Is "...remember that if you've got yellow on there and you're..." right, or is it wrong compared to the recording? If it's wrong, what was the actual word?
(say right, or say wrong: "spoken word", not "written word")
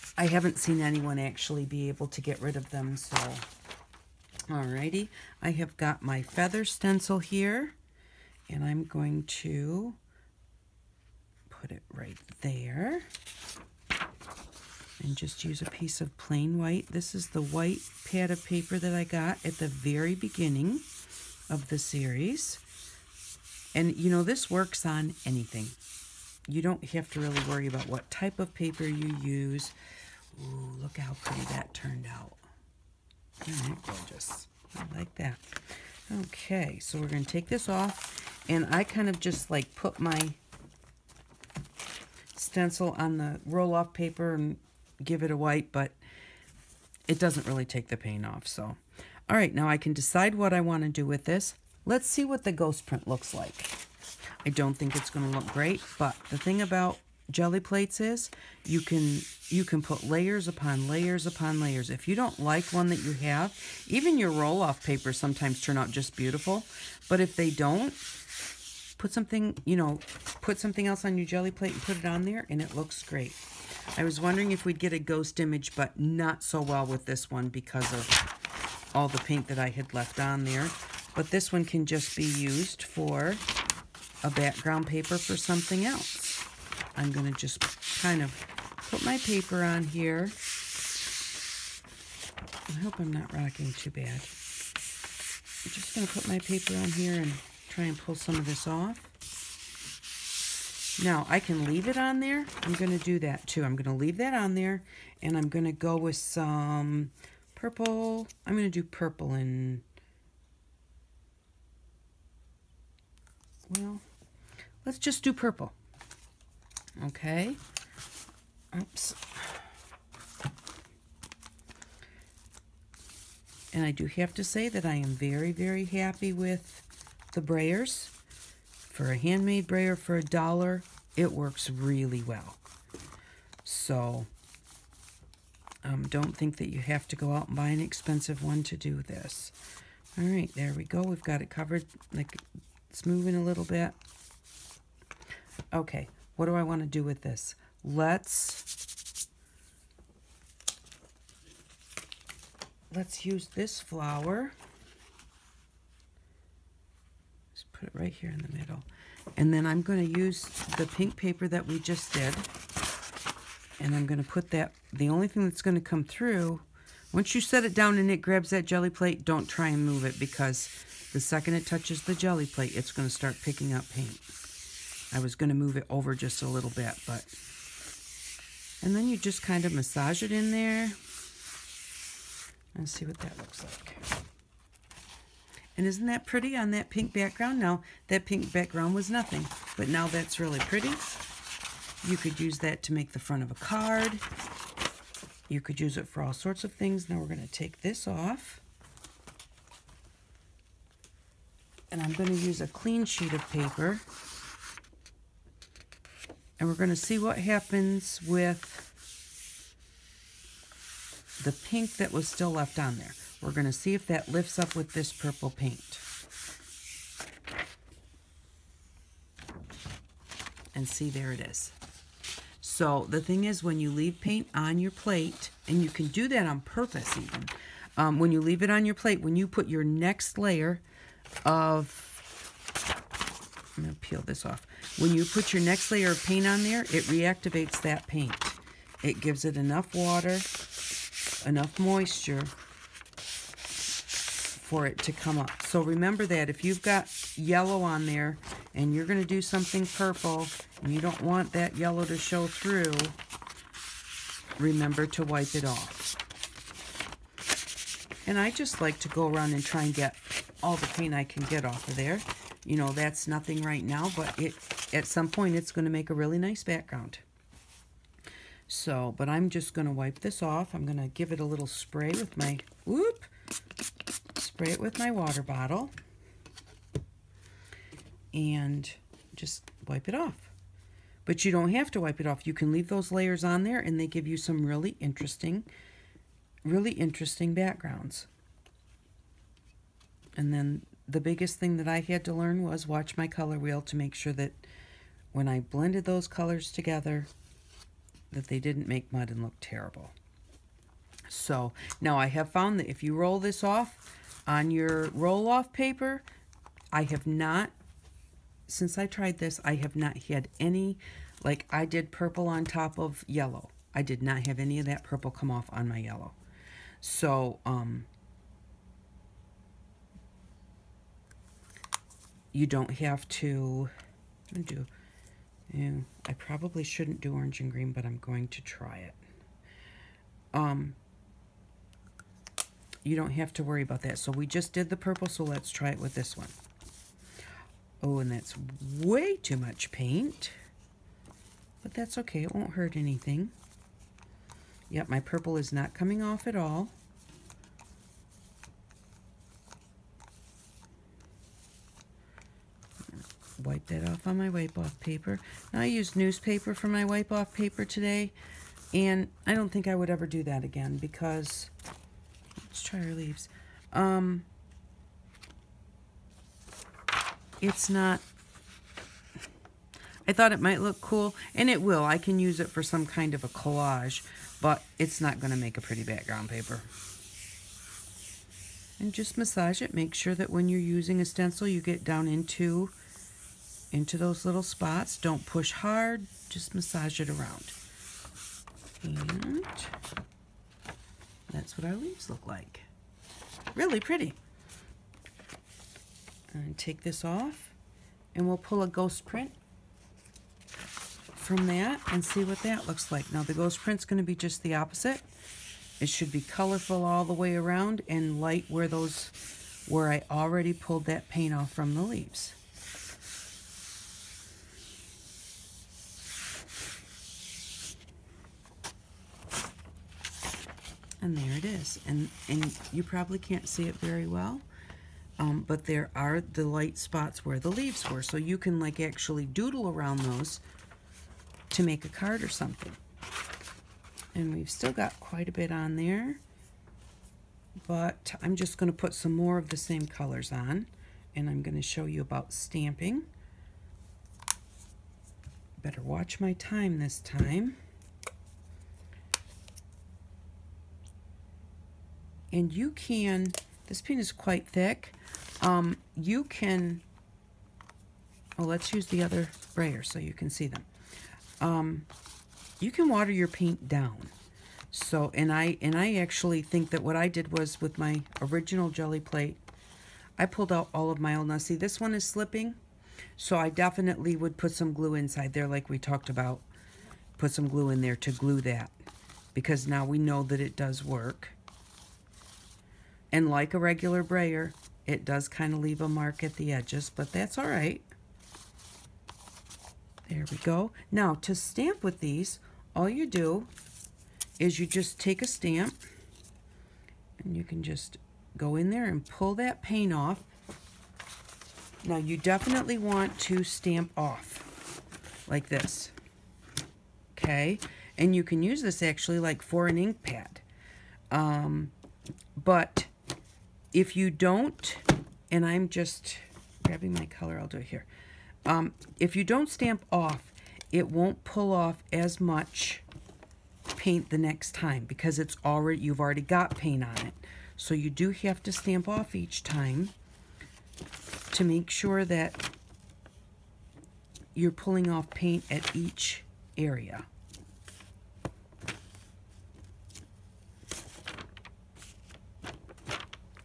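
right.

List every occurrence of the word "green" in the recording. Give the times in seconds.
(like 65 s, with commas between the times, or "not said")
327 s.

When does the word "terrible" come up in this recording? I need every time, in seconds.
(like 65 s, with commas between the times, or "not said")
299 s.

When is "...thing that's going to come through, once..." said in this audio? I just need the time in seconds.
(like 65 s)
165 s.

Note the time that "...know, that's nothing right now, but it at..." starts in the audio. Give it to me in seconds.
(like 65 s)
262 s.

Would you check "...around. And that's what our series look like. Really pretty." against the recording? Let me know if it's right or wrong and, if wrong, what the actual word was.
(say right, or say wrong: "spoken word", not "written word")
wrong: "leaves", not "series".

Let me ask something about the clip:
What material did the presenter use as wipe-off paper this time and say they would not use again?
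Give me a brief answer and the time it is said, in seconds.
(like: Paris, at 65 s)
Newspaper, at 356 s.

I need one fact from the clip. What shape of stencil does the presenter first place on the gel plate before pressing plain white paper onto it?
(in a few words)
Feather.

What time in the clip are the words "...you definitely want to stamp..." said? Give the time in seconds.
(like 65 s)
502 s.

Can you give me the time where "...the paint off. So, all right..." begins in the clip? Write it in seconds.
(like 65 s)
47 s.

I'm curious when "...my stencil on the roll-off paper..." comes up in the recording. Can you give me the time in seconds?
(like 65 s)
39 s.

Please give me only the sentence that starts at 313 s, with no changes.
I did not have any of that purple come off on my yellow.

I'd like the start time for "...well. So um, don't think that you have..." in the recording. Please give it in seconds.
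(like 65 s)
132 s.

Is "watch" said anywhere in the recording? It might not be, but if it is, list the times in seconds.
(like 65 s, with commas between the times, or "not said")
292 s, 446 s.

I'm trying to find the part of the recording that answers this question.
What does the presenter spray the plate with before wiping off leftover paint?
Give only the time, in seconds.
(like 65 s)
275 s.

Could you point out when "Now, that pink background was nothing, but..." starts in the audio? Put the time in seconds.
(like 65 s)
187 s.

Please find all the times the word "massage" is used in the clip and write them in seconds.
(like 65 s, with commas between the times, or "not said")
179 s, 379 s, 386 s.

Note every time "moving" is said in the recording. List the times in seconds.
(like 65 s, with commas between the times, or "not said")
143 s.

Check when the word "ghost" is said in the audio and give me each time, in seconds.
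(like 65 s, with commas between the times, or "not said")
52 s, 74 s, 398 s, 403 s.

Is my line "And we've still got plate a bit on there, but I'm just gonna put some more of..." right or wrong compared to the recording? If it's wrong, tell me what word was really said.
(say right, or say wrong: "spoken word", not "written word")
wrong: "quite", not "plate".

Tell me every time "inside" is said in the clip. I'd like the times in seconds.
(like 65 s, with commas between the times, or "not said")
475 s.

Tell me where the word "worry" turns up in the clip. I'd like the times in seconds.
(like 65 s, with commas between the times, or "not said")
27 s, 333 s.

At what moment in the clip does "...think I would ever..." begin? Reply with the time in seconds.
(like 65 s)
359 s.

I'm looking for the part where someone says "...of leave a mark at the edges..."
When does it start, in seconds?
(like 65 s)
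485 s.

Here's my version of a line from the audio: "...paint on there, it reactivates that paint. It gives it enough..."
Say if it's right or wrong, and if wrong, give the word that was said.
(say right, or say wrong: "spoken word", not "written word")
right.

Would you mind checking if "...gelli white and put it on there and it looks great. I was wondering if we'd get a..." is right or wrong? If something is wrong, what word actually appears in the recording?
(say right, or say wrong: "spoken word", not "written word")
wrong: "plate", not "white".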